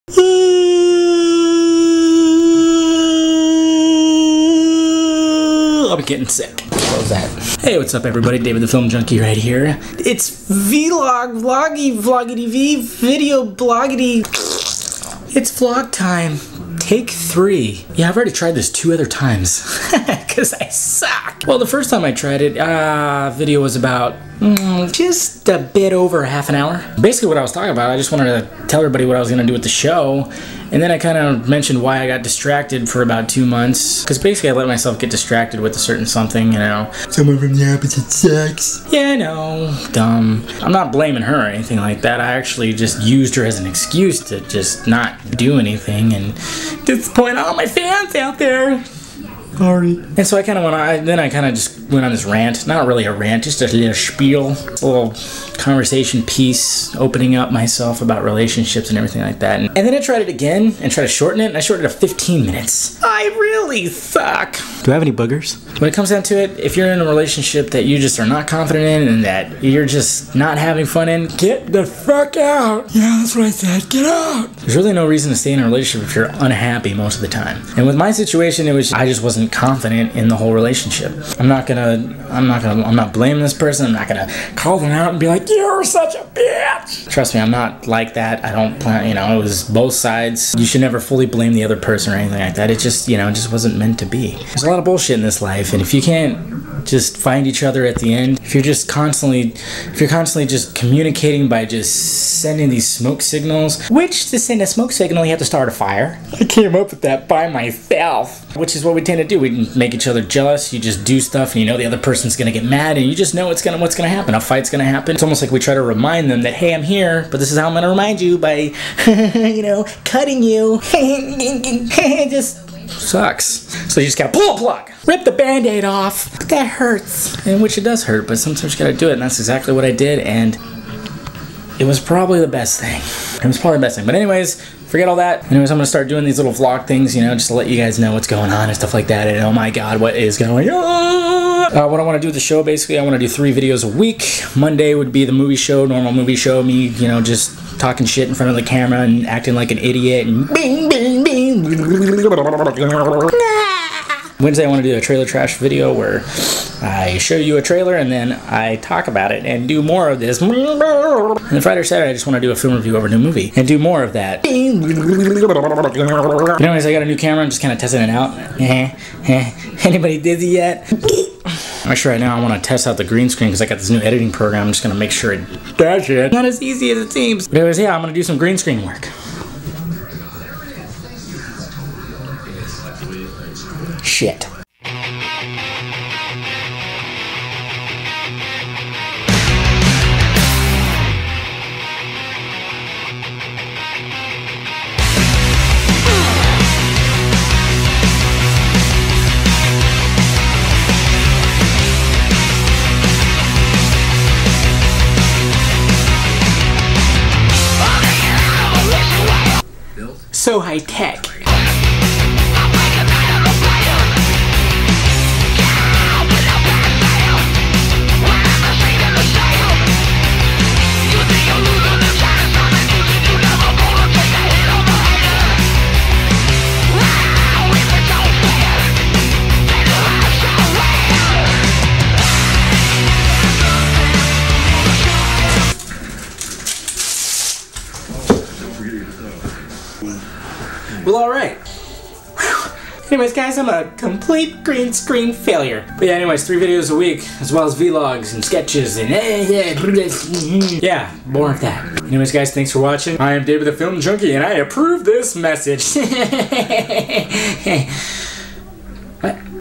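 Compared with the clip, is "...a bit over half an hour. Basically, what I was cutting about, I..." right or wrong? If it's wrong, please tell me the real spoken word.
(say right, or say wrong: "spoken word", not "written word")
wrong: "talking", not "cutting".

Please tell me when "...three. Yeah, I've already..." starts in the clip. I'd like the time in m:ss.
0:17.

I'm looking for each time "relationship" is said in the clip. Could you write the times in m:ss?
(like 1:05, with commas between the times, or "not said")
0:58, 1:07, 1:15, 1:20.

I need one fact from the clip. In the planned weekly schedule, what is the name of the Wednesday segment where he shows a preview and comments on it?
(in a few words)
Trailer Trash.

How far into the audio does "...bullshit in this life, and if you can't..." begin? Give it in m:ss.
1:34.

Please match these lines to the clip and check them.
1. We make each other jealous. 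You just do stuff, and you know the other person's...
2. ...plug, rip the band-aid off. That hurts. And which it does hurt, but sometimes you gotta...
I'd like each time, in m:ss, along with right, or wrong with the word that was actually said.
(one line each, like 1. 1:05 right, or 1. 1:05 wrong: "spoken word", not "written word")
1. 1:49 right
2. 2:04 right.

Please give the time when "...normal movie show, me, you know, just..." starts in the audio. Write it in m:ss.
2:25.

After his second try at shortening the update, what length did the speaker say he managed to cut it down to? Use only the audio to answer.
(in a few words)
15 minutes.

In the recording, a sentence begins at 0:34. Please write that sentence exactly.
Because basically, I let myself get distracted with a certain something, you know.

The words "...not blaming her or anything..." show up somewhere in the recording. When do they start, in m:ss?
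0:40.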